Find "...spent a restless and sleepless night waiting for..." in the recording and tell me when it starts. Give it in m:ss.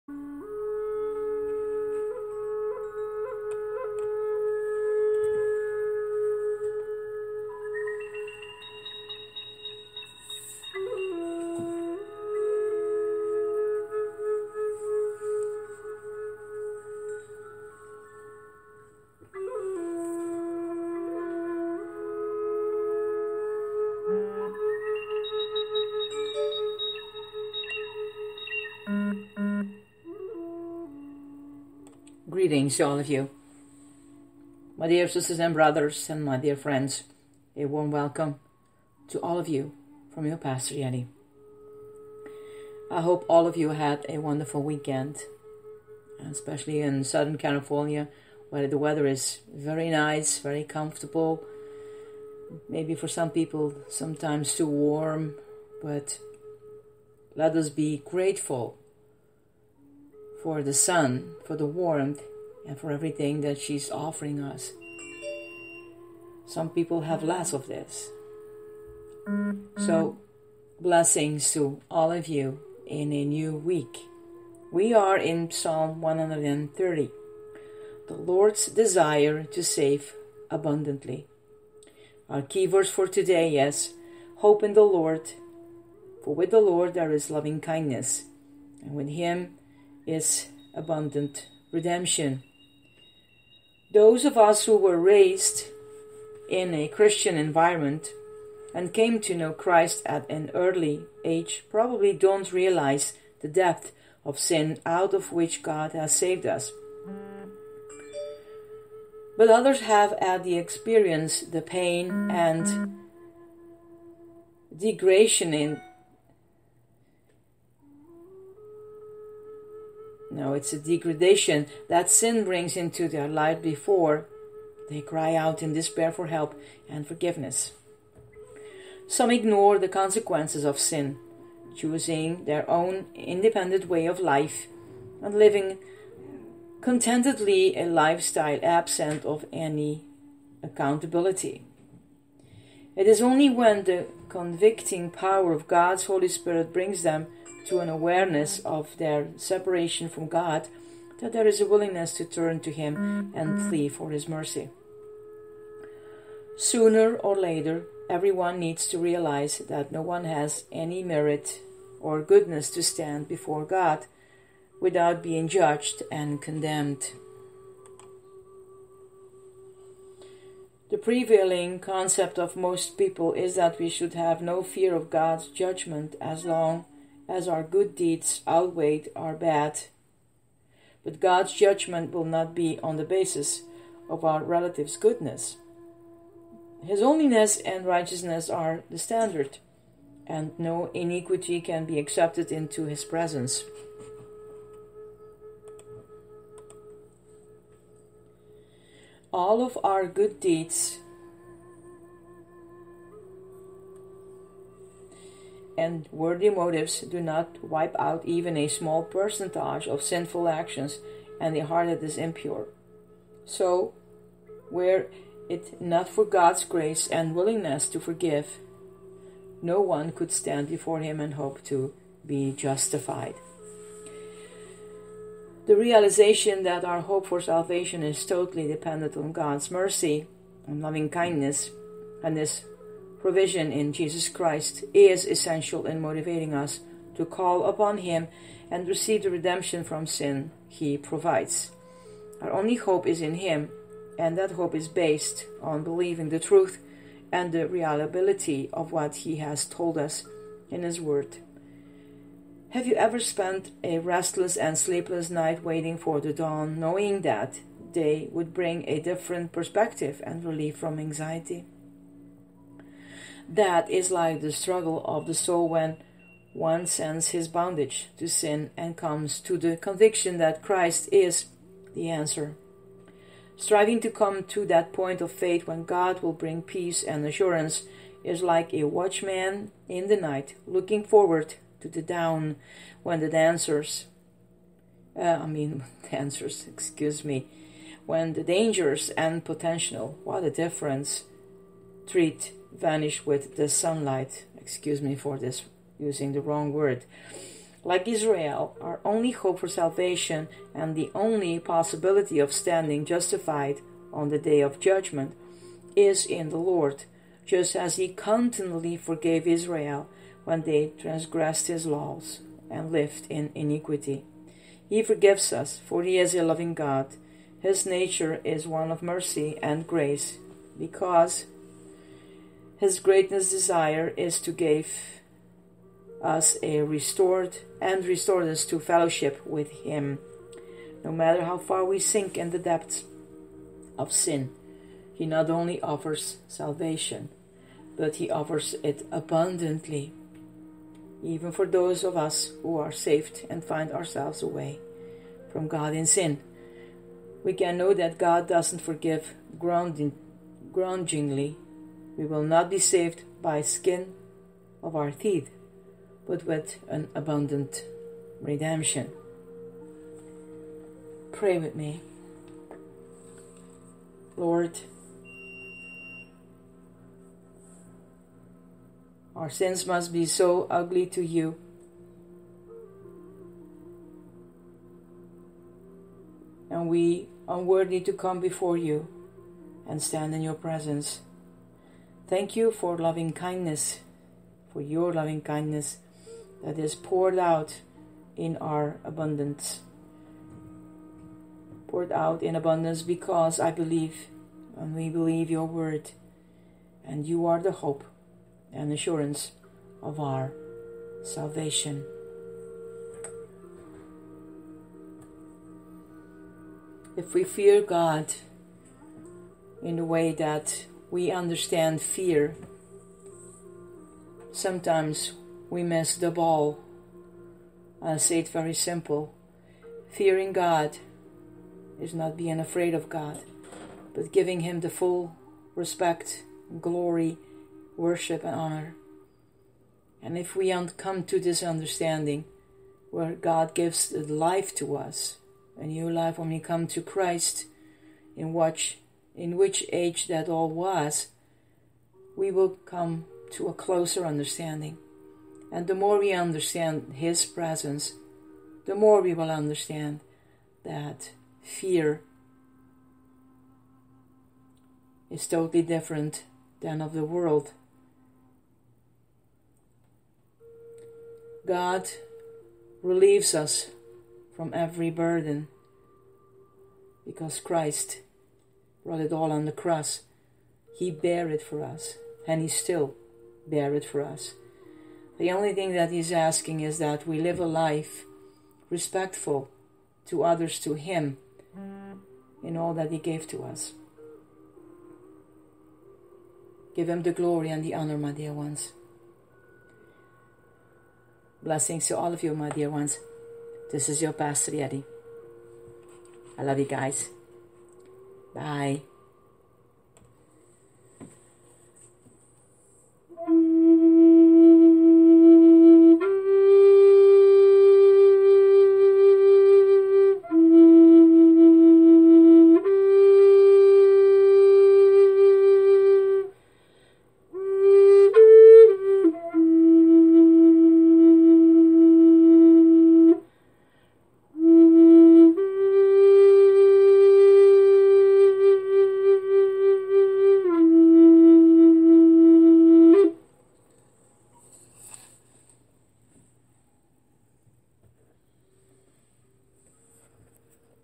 4:13.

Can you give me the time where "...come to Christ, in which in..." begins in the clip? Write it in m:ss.
7:16.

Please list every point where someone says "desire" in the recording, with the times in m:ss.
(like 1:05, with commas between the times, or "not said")
1:18, 5:23.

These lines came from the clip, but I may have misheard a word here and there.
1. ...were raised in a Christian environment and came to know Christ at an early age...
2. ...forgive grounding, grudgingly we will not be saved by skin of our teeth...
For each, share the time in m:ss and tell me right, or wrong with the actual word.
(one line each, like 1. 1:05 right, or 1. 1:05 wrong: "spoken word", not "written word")
1. 1:34 right
2. 5:48 right.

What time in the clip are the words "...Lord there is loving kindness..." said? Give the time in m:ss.
1:26.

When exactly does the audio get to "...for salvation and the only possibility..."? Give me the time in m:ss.
4:59.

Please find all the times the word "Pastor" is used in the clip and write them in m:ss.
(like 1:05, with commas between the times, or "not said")
0:40, 8:14.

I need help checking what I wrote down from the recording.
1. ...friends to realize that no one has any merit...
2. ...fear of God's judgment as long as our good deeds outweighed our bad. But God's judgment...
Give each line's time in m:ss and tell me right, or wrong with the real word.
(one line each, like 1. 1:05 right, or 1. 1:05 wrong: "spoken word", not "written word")
1. 2:38 wrong: "needs", not "friends"
2. 2:54 right.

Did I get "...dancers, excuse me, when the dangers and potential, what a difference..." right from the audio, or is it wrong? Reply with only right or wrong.
right.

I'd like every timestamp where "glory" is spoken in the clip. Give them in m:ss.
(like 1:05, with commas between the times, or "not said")
7:06, 8:07.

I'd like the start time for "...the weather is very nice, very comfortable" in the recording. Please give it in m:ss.
0:48.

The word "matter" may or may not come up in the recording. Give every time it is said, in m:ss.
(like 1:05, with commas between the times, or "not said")
5:31.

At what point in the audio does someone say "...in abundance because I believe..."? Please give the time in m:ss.
6:32.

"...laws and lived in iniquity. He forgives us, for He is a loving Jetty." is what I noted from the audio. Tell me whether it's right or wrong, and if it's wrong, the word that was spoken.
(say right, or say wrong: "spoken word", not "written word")
wrong: "God", not "Jetty".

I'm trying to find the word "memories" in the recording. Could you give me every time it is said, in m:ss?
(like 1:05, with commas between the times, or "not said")
not said.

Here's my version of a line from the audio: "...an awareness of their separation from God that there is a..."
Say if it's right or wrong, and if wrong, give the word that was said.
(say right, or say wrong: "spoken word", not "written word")
right.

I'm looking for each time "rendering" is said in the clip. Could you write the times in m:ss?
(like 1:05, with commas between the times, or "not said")
not said.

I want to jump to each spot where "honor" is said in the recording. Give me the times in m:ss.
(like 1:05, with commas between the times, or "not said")
7:08, 8:07.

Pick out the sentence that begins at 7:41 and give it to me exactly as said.
God relieves us from every burden because Christ brought it all on the cross.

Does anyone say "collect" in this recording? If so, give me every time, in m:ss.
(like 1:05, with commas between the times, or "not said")
not said.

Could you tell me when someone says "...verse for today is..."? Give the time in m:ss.
1:22.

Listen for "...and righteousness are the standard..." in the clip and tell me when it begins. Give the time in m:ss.
3:07.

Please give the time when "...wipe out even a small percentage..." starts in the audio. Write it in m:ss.
3:27.